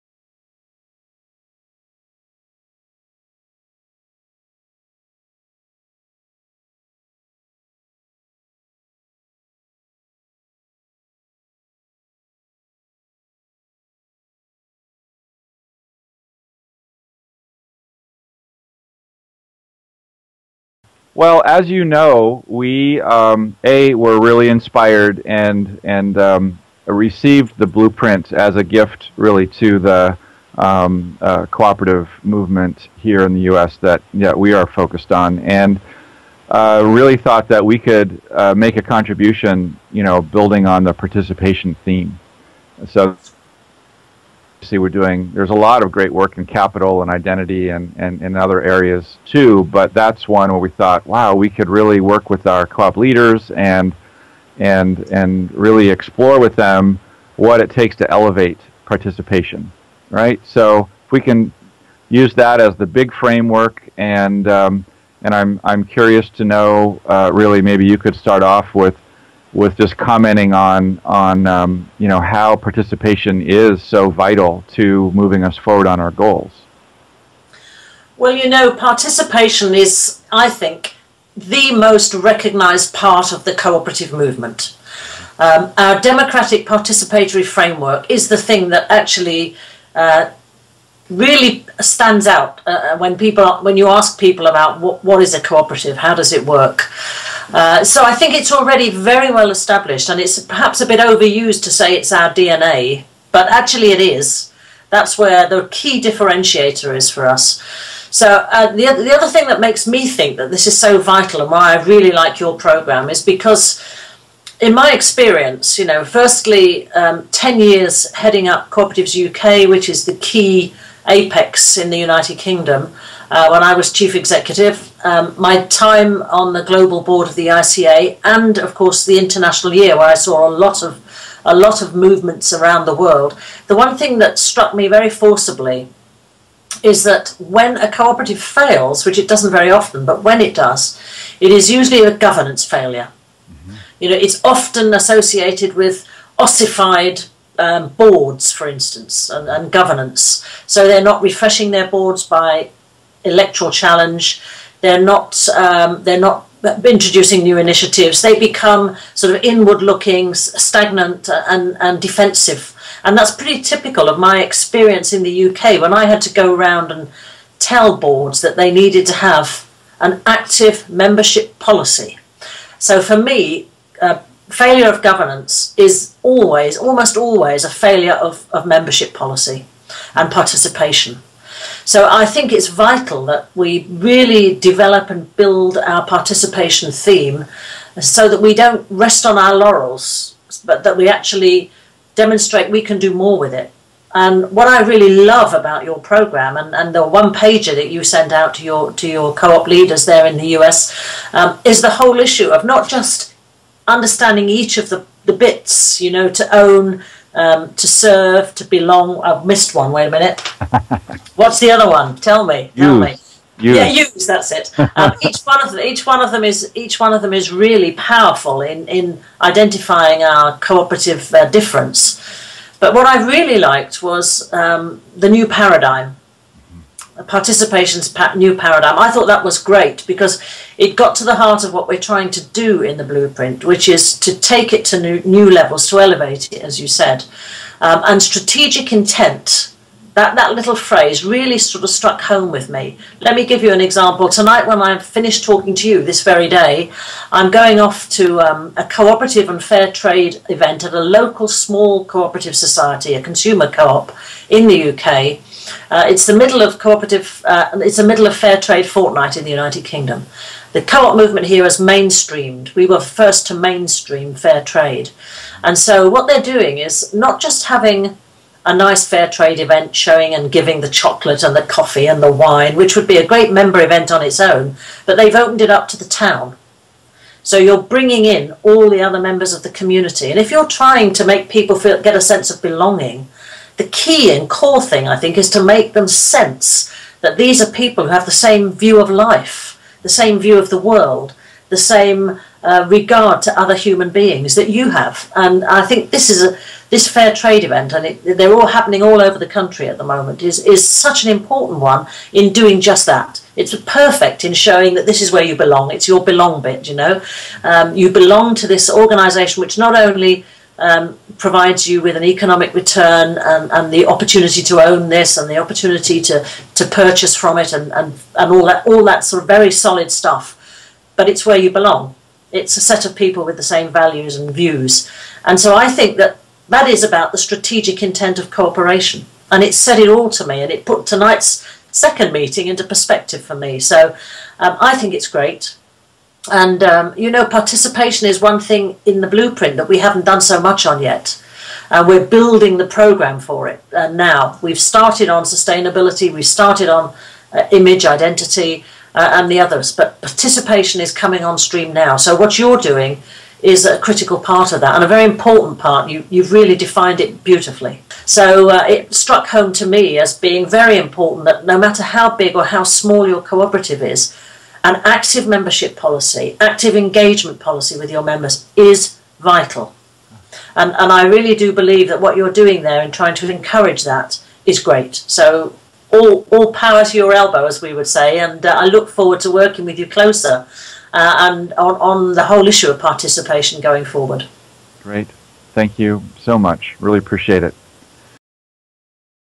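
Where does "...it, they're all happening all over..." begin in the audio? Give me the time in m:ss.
4:58.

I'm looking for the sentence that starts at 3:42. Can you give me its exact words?
But what I really liked was um, the new paradigm participation's new paradigm.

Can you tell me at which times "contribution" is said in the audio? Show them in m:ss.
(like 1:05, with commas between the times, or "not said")
0:38.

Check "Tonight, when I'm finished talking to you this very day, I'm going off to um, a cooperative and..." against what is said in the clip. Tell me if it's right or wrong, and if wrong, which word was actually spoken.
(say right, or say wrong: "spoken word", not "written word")
right.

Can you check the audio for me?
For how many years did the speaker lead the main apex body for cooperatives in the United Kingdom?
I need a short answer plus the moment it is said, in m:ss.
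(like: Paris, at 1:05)
10, at 1:57.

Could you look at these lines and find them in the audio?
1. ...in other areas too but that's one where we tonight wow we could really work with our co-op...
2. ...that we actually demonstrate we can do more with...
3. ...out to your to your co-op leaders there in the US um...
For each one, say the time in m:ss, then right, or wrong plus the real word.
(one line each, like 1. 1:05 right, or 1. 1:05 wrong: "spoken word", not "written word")
1. 0:48 wrong: "thought", not "tonight"
2. 3:10 right
3. 3:18 right.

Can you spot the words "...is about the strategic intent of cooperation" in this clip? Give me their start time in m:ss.
5:26.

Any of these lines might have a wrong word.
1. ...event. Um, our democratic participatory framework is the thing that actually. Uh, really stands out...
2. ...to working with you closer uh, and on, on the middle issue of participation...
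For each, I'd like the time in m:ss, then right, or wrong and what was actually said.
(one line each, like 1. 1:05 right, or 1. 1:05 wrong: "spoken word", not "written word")
1. 1:24 wrong: "movement", not "event"
2. 6:19 wrong: "whole", not "middle".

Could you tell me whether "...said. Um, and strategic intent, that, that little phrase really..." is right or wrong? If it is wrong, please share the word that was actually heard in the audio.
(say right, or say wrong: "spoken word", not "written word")
right.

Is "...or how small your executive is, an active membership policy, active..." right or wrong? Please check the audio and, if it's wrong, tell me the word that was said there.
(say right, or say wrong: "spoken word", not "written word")
wrong: "cooperative", not "executive".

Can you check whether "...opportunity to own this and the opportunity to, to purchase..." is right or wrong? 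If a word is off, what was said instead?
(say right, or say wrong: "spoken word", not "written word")
right.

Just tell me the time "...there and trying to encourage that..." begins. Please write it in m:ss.
6:12.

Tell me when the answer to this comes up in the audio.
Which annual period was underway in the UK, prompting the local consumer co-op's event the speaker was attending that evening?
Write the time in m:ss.
4:18.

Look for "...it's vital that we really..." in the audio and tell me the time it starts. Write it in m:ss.
3:02.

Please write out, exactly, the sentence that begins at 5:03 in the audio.
It's perfect in showing that this is where you belong.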